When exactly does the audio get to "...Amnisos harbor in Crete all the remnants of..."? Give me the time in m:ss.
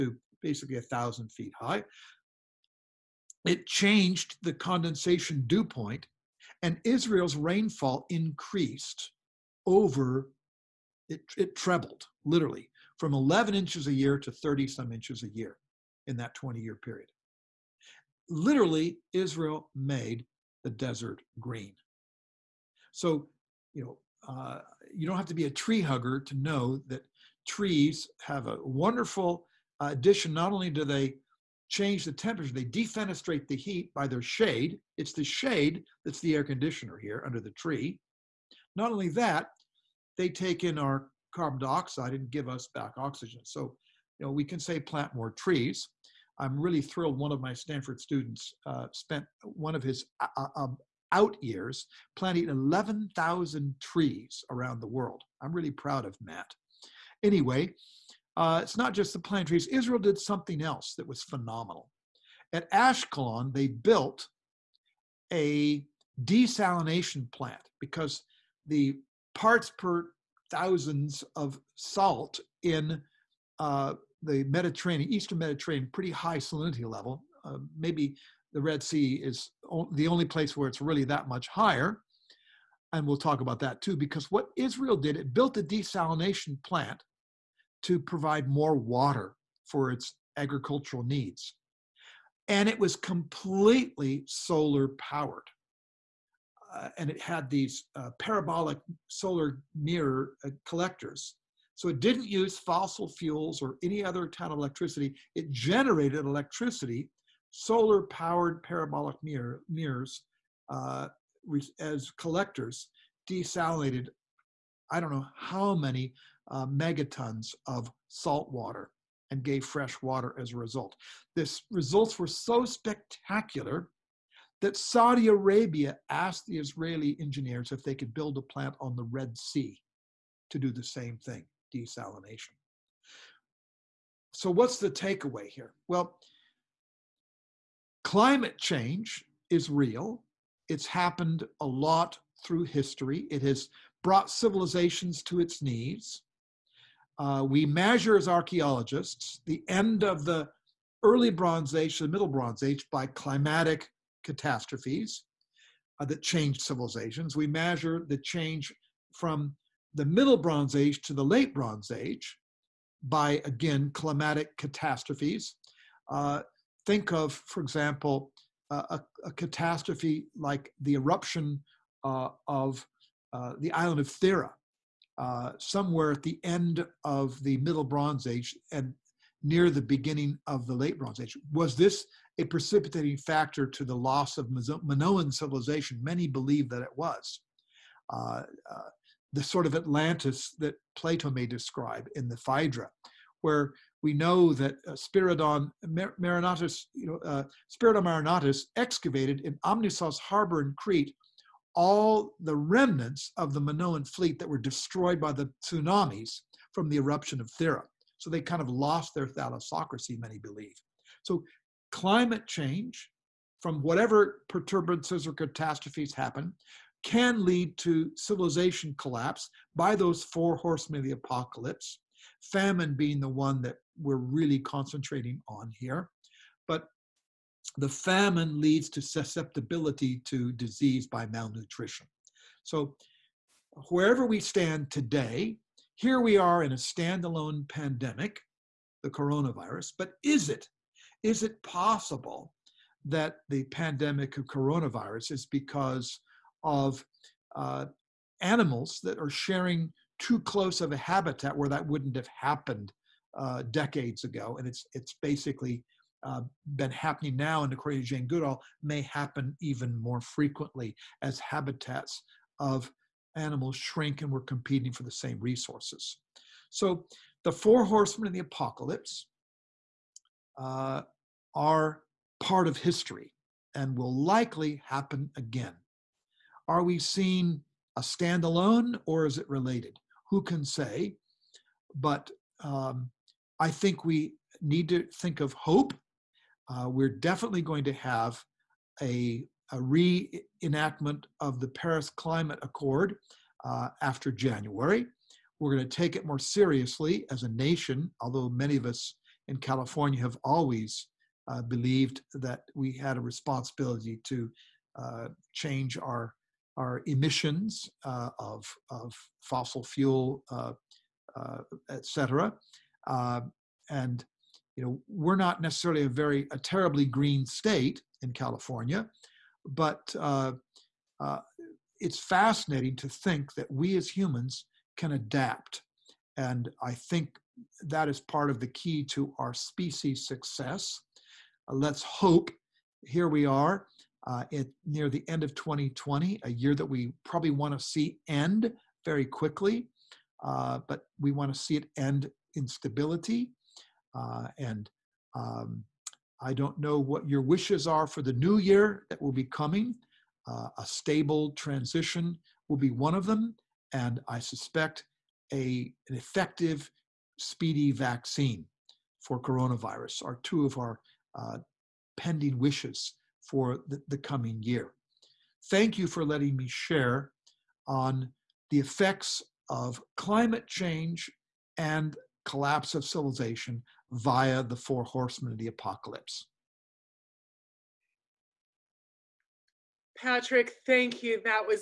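3:19.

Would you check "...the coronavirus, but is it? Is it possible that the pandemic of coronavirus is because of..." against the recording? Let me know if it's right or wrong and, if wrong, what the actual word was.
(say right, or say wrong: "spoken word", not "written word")
right.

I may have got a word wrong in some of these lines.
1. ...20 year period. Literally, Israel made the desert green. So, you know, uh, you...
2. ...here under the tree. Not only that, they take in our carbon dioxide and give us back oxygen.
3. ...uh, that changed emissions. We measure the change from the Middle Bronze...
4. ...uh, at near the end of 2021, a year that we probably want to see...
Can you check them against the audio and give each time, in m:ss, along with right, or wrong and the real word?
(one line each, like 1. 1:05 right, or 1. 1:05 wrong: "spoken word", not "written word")
1. 0:16 right
2. 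0:36 right
3. 2:35 wrong: "civilizations", not "emissions"
4. 5:34 wrong: "2020", not "2021".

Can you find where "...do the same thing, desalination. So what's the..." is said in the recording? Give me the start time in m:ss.
2:10.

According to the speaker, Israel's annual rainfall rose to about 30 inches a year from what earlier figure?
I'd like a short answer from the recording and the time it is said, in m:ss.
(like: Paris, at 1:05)
11 inches, at 0:13.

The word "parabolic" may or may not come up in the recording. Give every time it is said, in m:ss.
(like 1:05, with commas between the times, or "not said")
1:38, 1:48.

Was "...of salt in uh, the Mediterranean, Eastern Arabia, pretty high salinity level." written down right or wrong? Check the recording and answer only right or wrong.
wrong.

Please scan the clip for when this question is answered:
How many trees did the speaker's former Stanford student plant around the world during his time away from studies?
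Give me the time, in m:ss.
0:52.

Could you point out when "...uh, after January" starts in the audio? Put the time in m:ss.
4:53.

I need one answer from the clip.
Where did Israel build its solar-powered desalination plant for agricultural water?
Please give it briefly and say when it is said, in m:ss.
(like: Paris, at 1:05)
Ashkelon, at 1:02.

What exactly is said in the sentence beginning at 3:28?
So they kind of lost their thalassocracy, many believe.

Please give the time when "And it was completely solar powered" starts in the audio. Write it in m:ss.
1:32.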